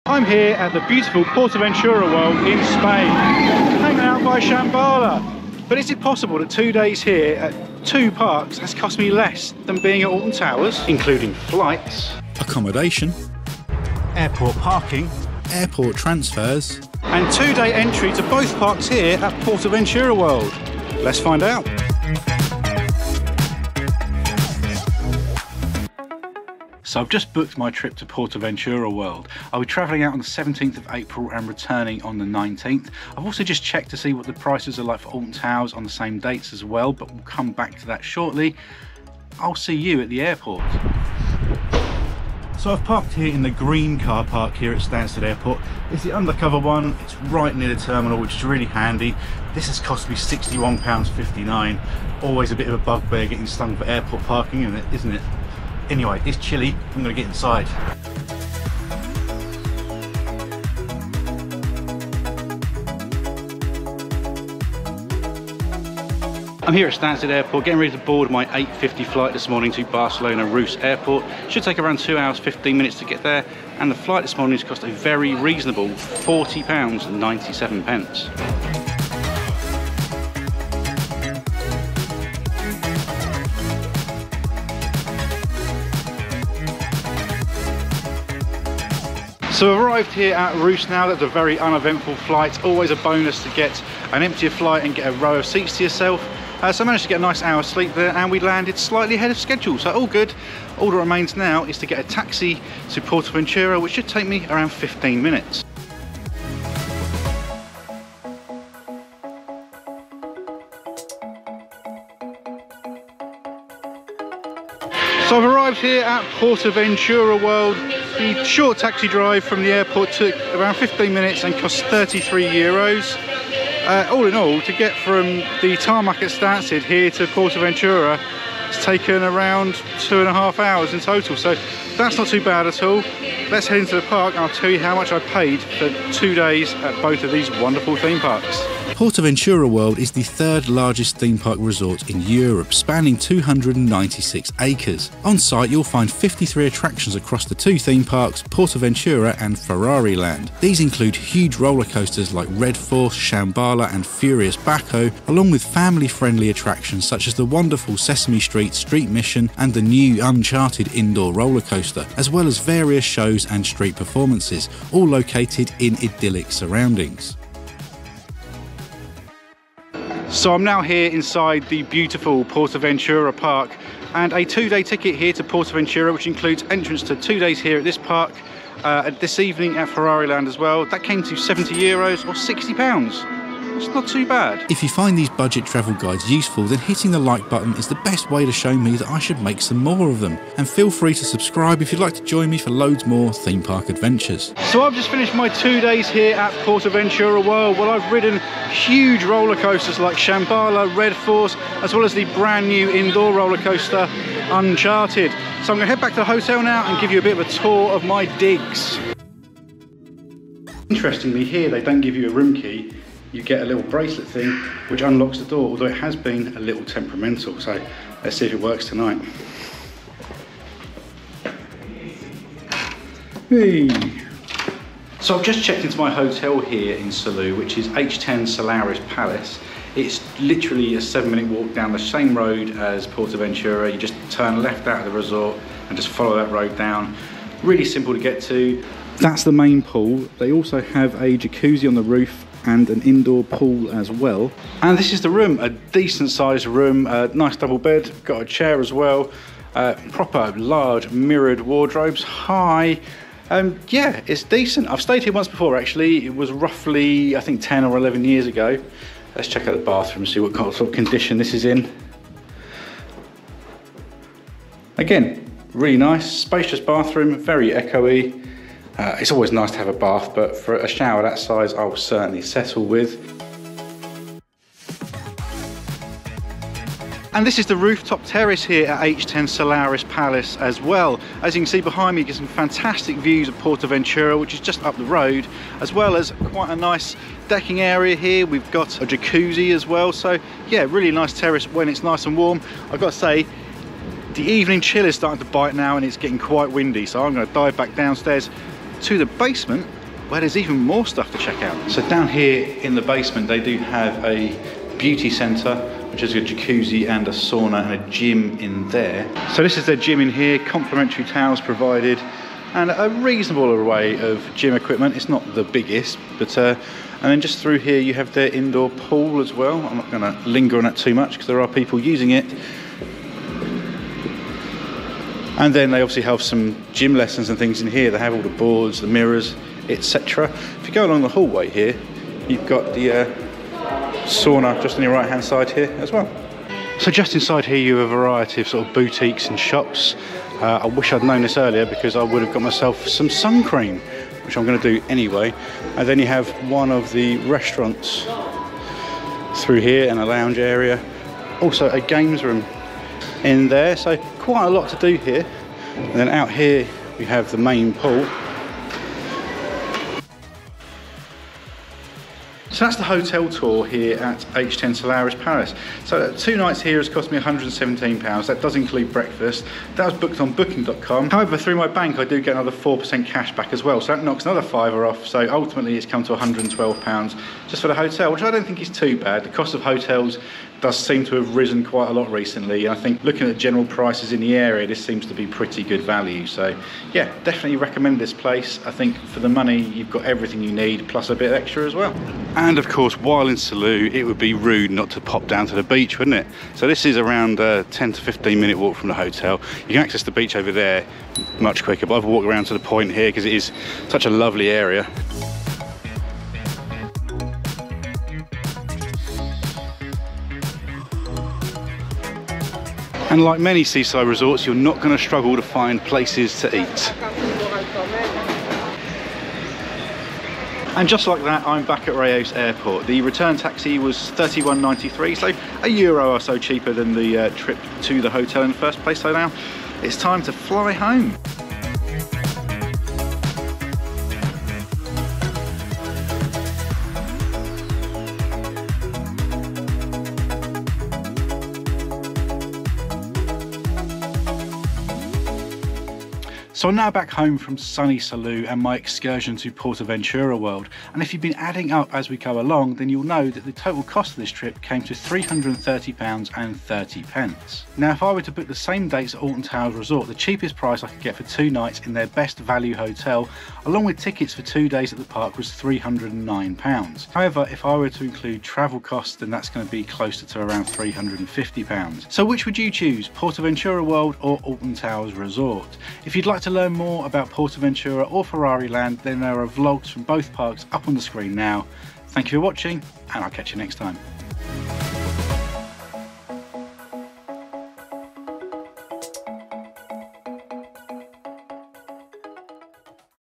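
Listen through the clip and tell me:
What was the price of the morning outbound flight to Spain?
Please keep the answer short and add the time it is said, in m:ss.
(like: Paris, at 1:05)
£40.97, at 1:15.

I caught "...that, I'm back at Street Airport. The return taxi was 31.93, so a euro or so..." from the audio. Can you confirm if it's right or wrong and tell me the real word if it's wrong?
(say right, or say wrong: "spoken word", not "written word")
wrong: "Reus", not "Street".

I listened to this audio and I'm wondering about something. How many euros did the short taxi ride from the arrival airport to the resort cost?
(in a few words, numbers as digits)
33 euros.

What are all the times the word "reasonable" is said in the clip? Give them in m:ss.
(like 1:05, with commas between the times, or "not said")
1:15, 5:13.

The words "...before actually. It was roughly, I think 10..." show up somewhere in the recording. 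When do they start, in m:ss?
4:15.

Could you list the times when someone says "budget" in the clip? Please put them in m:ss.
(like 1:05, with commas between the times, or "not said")
3:05.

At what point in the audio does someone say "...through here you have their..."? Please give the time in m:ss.
5:17.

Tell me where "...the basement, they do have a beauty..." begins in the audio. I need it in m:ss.
5:02.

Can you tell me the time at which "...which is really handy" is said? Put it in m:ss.
0:48.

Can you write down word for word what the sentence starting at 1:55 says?
So I've arrived here at Portaventura World.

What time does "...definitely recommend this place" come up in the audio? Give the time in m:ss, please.
6:27.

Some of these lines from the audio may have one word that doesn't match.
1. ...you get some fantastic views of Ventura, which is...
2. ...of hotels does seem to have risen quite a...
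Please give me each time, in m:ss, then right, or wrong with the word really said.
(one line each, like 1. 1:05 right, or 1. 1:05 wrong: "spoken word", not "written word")
1. 4:42 right
2. 6:19 right.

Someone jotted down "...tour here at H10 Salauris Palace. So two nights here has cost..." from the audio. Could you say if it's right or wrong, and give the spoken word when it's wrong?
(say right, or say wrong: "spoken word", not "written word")
right.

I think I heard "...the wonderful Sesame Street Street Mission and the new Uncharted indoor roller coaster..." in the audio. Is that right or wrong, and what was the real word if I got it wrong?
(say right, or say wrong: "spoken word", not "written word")
right.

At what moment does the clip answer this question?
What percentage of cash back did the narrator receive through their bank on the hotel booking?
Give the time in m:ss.
6:12.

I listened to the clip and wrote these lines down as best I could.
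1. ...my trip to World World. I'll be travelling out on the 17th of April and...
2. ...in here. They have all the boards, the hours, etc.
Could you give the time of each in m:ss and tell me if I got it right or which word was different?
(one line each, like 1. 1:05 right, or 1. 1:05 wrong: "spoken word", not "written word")
1. 0:27 wrong: "Portaventura", not "World"
2. 5:27 wrong: "mirrors", not "hours".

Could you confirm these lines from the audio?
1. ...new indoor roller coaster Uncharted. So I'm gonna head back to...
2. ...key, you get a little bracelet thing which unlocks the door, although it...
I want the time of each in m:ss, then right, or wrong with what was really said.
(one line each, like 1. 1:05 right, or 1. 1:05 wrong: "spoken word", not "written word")
1. 3:22 right
2. 3:32 right.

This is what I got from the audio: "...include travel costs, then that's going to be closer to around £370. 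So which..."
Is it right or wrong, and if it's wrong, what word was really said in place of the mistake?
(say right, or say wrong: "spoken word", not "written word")
wrong: "350", not "370".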